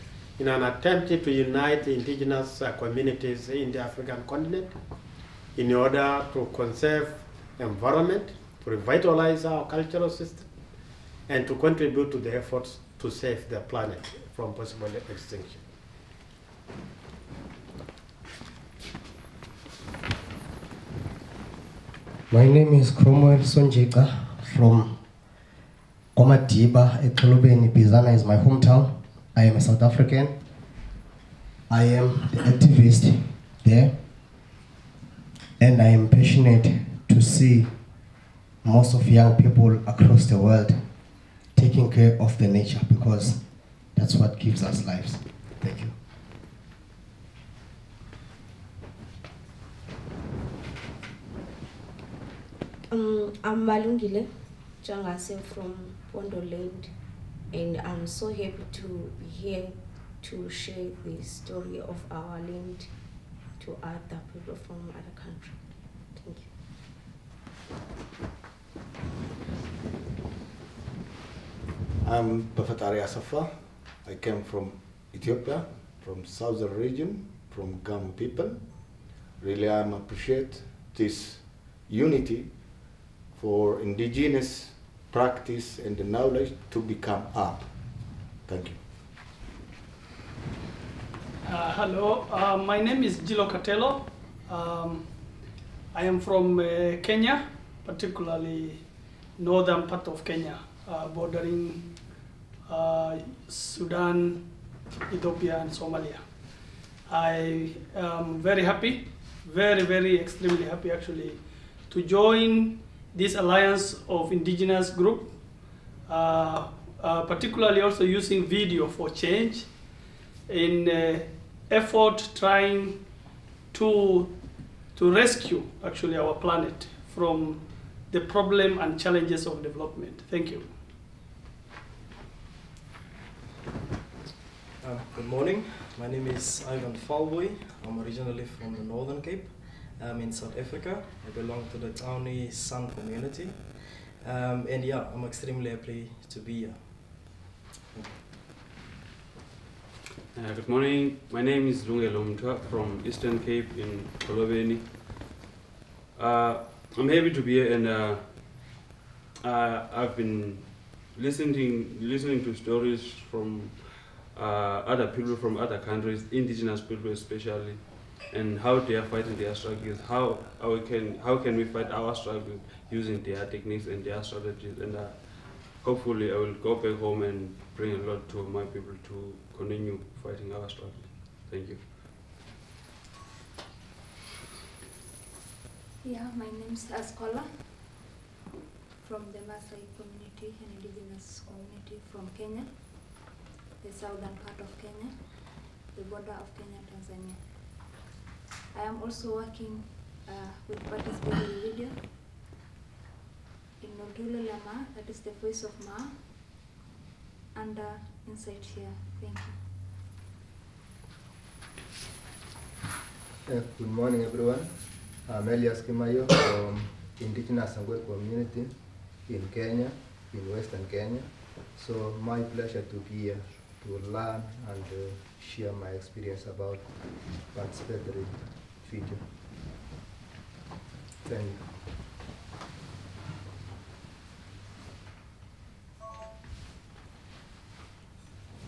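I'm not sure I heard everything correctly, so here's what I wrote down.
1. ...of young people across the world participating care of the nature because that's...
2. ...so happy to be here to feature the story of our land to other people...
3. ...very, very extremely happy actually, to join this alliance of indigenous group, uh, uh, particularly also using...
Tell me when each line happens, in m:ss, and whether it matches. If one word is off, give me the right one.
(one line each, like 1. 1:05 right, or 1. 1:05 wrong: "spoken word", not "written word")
1. 0:38 wrong: "taking", not "participating"
2. 0:58 wrong: "share", not "feature"
3. 1:49 right.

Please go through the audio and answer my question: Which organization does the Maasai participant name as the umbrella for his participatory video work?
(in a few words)
InsightShare.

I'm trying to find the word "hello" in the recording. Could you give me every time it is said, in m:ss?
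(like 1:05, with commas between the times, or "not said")
1:31.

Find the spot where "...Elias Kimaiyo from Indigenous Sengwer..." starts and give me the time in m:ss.
3:35.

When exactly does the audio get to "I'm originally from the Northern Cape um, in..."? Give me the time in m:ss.
2:17.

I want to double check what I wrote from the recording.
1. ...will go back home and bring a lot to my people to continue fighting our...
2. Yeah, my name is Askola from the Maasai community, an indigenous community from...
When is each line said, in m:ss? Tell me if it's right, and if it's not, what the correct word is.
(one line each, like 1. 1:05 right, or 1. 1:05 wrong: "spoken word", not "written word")
1. 2:56 right
2. 3:06 right.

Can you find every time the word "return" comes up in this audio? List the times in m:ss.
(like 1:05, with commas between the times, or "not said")
not said.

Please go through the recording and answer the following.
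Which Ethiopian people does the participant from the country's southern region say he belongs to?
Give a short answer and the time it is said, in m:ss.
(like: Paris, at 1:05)
Gamo, at 1:17.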